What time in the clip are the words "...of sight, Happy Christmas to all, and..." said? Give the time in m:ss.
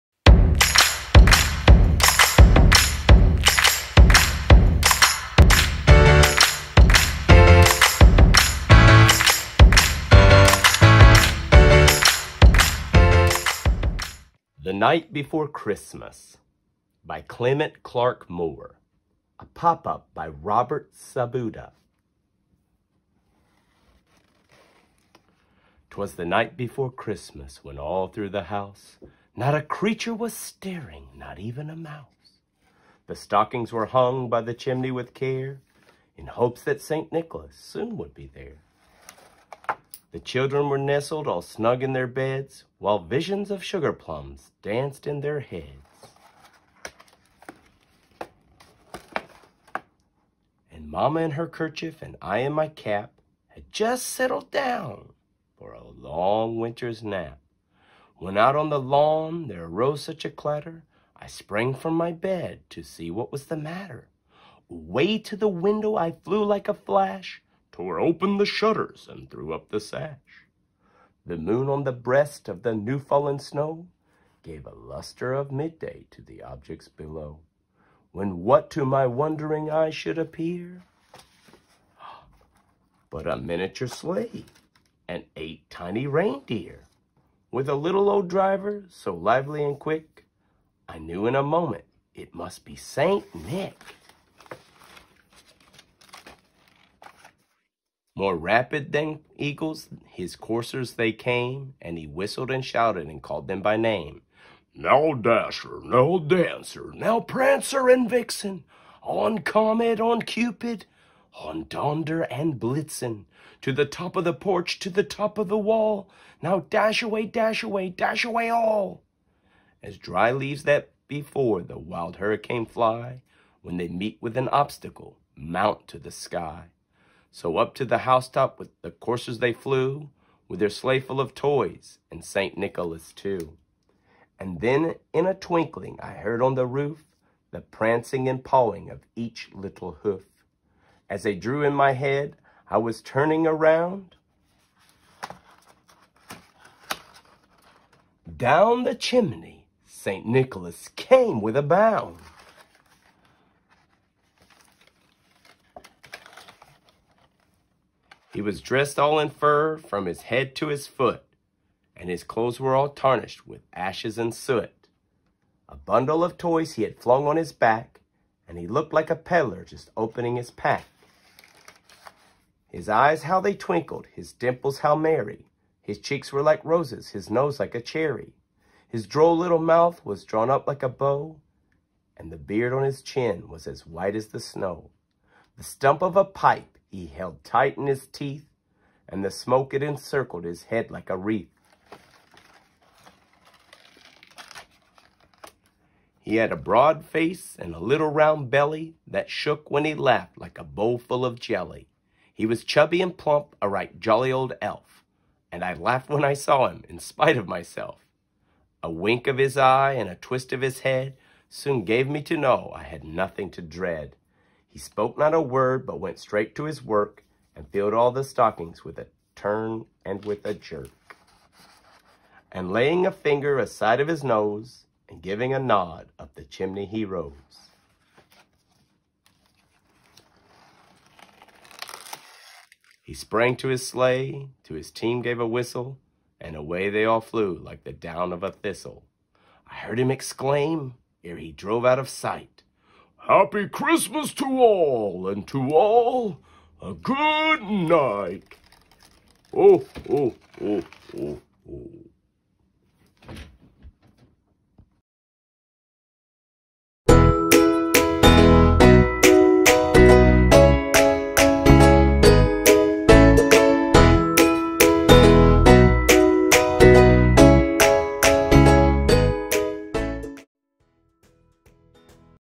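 4:01.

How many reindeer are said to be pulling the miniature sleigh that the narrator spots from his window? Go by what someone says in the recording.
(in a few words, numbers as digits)
8.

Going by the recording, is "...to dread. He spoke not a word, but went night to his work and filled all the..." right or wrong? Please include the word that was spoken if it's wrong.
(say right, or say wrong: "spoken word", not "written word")
wrong: "straight", not "night".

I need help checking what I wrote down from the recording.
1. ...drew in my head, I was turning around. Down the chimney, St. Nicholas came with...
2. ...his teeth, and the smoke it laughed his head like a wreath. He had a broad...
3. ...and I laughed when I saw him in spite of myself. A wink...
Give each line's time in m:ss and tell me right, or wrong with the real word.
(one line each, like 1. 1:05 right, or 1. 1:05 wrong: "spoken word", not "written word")
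1. 2:21 right
2. 3:07 wrong: "encircled", not "laughed"
3. 3:25 right.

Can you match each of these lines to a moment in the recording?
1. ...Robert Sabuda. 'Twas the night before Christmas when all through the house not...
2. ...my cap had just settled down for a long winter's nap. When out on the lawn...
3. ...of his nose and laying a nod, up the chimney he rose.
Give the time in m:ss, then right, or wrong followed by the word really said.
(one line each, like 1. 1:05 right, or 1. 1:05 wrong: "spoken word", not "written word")
1. 0:20 right
2. 0:52 right
3. 3:43 wrong: "giving", not "laying".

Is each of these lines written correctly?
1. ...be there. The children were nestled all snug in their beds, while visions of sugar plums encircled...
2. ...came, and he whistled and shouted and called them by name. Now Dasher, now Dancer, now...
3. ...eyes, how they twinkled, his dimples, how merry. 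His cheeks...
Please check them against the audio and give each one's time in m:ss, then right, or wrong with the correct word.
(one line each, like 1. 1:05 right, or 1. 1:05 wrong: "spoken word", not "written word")
1. 0:38 wrong: "danced", not "encircled"
2. 1:41 right
3. 2:52 right.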